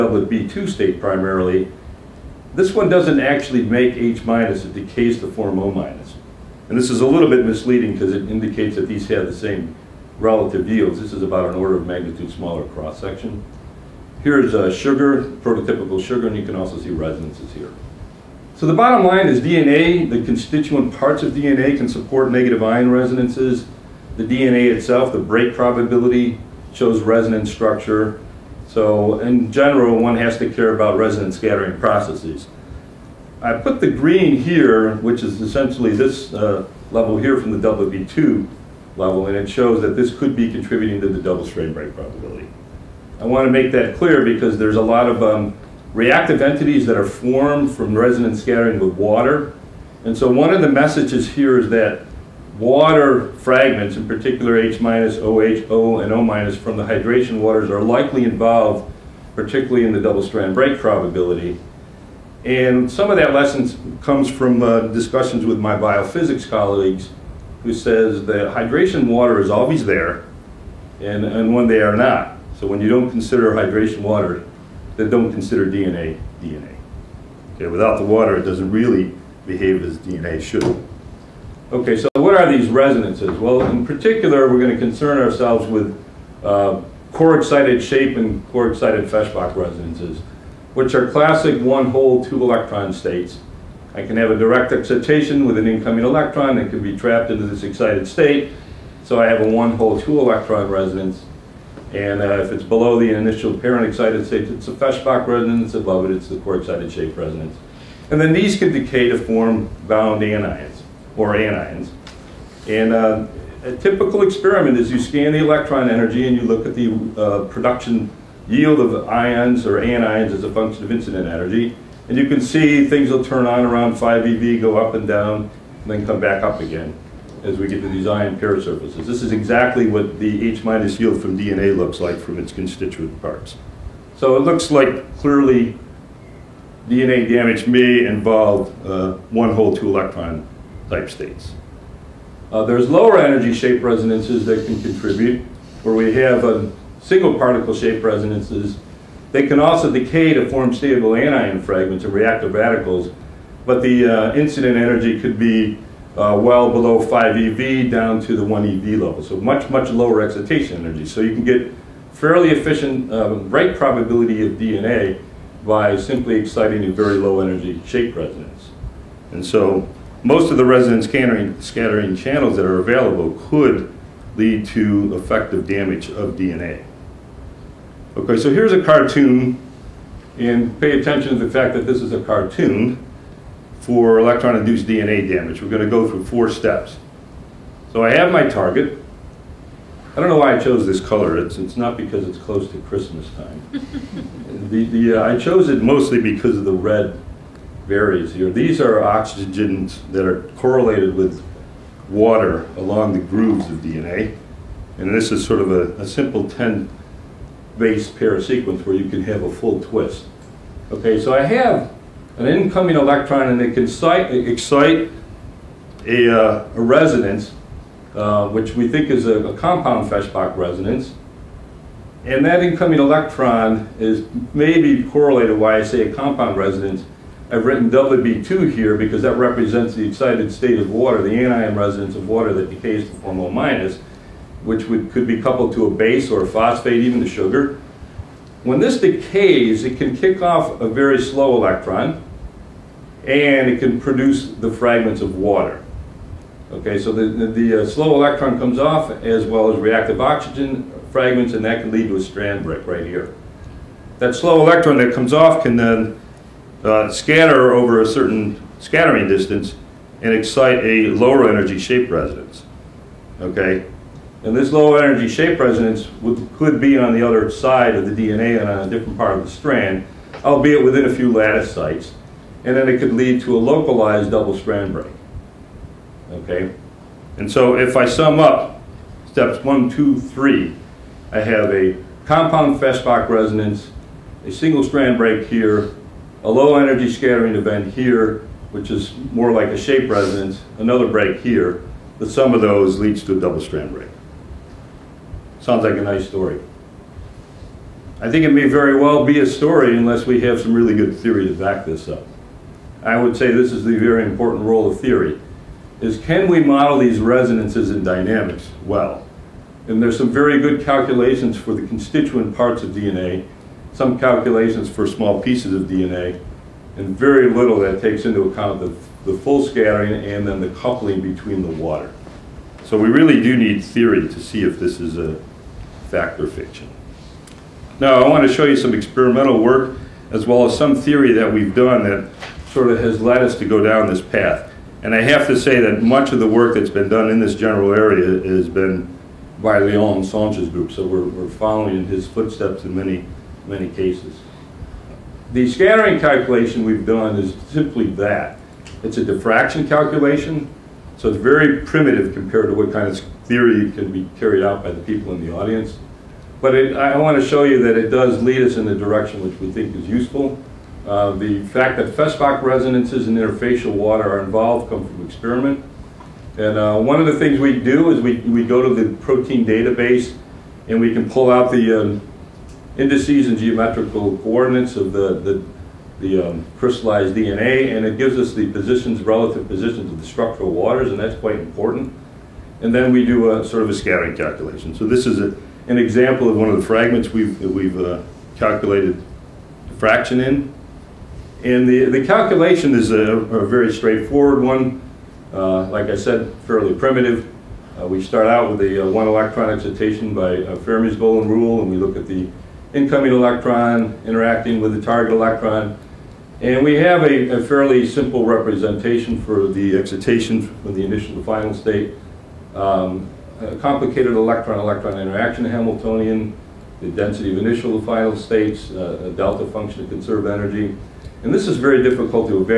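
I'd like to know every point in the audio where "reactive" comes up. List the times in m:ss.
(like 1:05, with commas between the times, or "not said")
0:45, 2:32, 4:09.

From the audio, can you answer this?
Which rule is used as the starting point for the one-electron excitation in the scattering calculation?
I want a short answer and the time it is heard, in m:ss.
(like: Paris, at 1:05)
Fermi's golden rule, at 6:40.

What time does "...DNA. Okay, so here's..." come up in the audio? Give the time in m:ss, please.
2:56.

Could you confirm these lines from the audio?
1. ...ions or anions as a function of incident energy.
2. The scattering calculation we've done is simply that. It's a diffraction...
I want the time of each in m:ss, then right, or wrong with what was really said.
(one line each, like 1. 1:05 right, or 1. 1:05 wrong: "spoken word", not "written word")
1. 1:59 right
2. 5:45 right.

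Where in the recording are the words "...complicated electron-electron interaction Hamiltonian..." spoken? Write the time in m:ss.
6:53.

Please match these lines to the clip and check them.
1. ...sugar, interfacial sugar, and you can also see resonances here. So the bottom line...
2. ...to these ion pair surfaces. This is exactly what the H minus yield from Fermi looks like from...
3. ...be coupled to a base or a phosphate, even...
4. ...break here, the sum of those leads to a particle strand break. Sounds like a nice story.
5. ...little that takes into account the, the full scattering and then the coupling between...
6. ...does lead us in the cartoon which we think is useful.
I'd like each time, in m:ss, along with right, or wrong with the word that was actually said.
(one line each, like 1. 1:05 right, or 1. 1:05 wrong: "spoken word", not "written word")
1. 0:14 wrong: "prototypical", not "interfacial"
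2. 2:07 wrong: "DNA", not "Fermi"
3. 3:55 right
4. 4:51 wrong: "double", not "particle"
5. 5:17 right
6. 5:58 wrong: "direction", not "cartoon".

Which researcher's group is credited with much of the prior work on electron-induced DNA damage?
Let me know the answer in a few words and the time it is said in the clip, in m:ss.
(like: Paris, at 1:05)
Leon Sanche, at 5:39.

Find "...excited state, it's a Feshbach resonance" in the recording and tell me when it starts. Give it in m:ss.
1:43.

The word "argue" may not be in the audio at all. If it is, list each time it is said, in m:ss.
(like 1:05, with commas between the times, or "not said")
not said.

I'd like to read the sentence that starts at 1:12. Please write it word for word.
So when you don't consider hydration water, then don't consider DNA DNA.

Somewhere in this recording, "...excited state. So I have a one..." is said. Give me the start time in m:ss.
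1:37.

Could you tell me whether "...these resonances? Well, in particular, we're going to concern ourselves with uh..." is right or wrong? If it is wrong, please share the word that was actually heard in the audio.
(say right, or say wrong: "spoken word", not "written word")
right.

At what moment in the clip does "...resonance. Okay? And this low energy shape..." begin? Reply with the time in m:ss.
4:22.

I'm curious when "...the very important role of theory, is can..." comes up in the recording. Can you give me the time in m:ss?
5:03.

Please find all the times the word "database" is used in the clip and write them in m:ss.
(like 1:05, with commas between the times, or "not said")
6:09.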